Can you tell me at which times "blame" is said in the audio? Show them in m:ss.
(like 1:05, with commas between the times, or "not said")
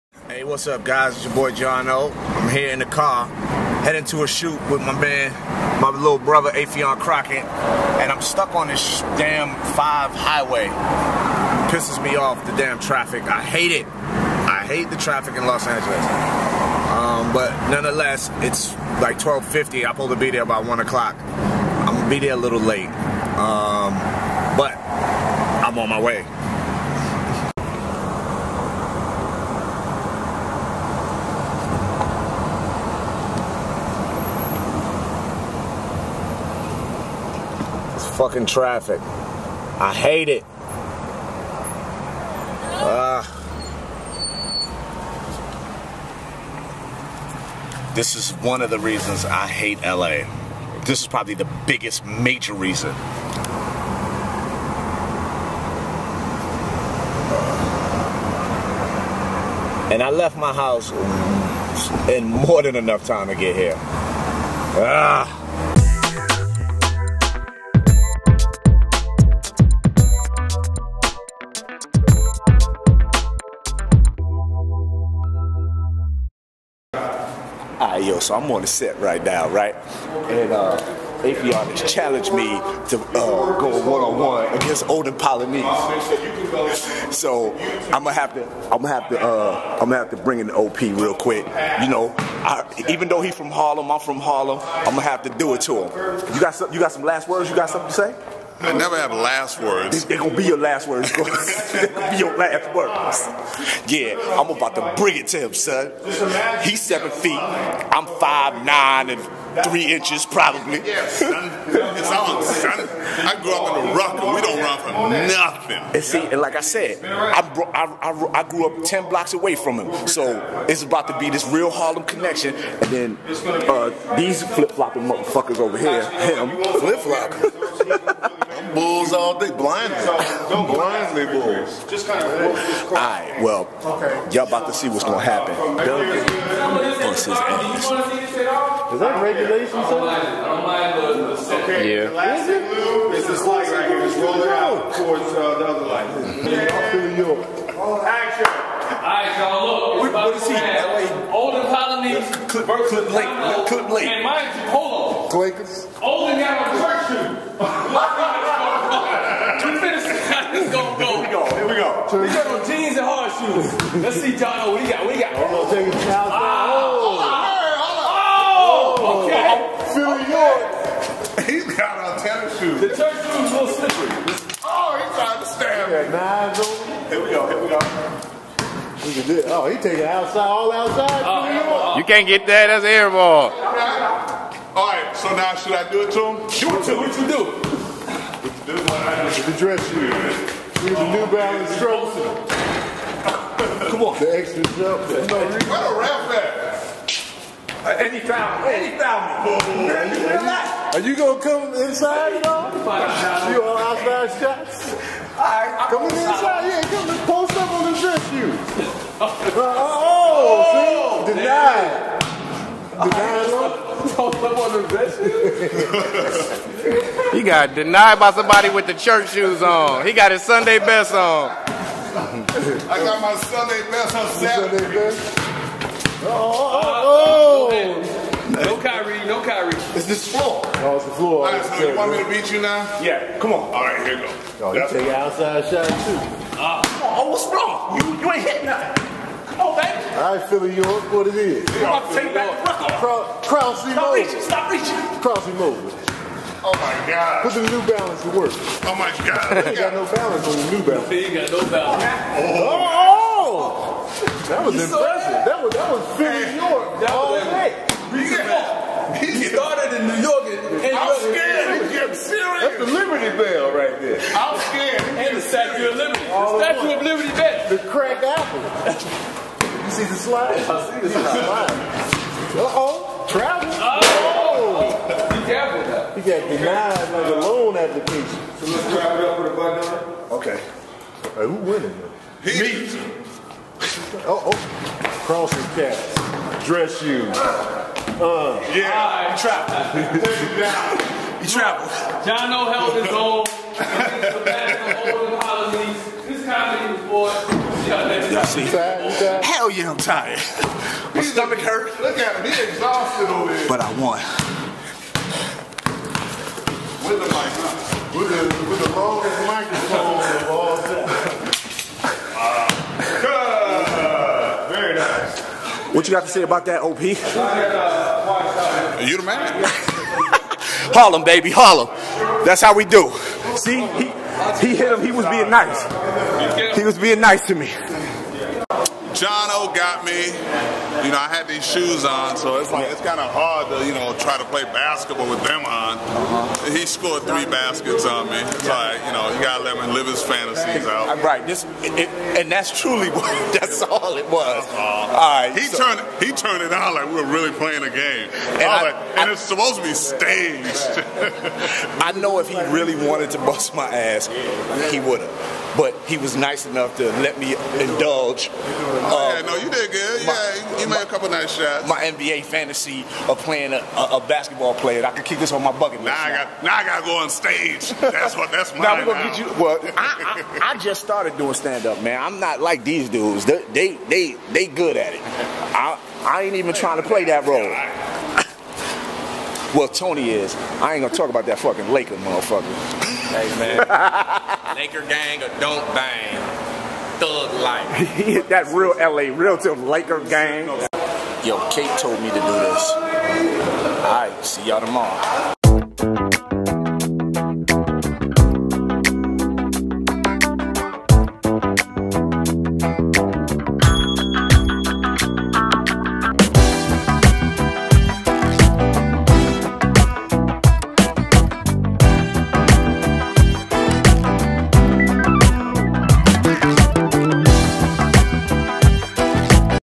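not said.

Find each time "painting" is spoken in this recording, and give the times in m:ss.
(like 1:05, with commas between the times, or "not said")
not said.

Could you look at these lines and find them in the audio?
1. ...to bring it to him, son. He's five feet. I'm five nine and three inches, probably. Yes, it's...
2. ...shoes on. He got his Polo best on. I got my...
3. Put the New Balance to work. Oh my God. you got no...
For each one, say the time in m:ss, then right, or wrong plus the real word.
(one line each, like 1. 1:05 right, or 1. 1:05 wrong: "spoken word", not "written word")
1. 1:44 wrong: "seven", not "five"
2. 3:39 wrong: "Sunday", not "Polo"
3. 4:07 right.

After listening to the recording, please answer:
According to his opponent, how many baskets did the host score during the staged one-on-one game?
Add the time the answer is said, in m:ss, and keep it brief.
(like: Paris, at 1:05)
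3, at 5:37.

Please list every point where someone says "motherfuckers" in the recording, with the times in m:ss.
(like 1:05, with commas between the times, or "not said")
2:05, 6:22.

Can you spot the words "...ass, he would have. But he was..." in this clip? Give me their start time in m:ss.
5:53.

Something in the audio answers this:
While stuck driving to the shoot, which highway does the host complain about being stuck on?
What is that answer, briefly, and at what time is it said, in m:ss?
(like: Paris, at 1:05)
The 5, at 0:09.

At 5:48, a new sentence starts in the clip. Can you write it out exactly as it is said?
And, I, like, and I, it's supposed to be staged.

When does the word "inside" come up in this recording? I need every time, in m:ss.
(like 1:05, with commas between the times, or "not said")
3:21, 3:26.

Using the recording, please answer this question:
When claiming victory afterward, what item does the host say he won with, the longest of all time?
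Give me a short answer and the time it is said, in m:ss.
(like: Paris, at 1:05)
Microphone, at 5:09.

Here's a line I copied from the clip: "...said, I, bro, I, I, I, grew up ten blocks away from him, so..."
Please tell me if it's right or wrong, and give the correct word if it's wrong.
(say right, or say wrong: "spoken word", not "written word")
right.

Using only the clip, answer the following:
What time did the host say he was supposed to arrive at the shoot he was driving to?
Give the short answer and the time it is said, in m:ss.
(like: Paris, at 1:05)
1:00, at 0:20.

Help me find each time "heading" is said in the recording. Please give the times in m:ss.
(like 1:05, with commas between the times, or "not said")
0:03.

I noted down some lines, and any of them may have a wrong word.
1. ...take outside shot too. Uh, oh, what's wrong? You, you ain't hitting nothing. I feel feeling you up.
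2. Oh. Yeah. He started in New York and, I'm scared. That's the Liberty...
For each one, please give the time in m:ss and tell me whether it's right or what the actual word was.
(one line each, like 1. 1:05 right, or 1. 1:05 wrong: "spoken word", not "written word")
1. 3:54 right
2. 4:17 right.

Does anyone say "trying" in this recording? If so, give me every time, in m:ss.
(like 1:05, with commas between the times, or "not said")
2:55, 6:16.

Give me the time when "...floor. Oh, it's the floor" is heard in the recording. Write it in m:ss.
3:50.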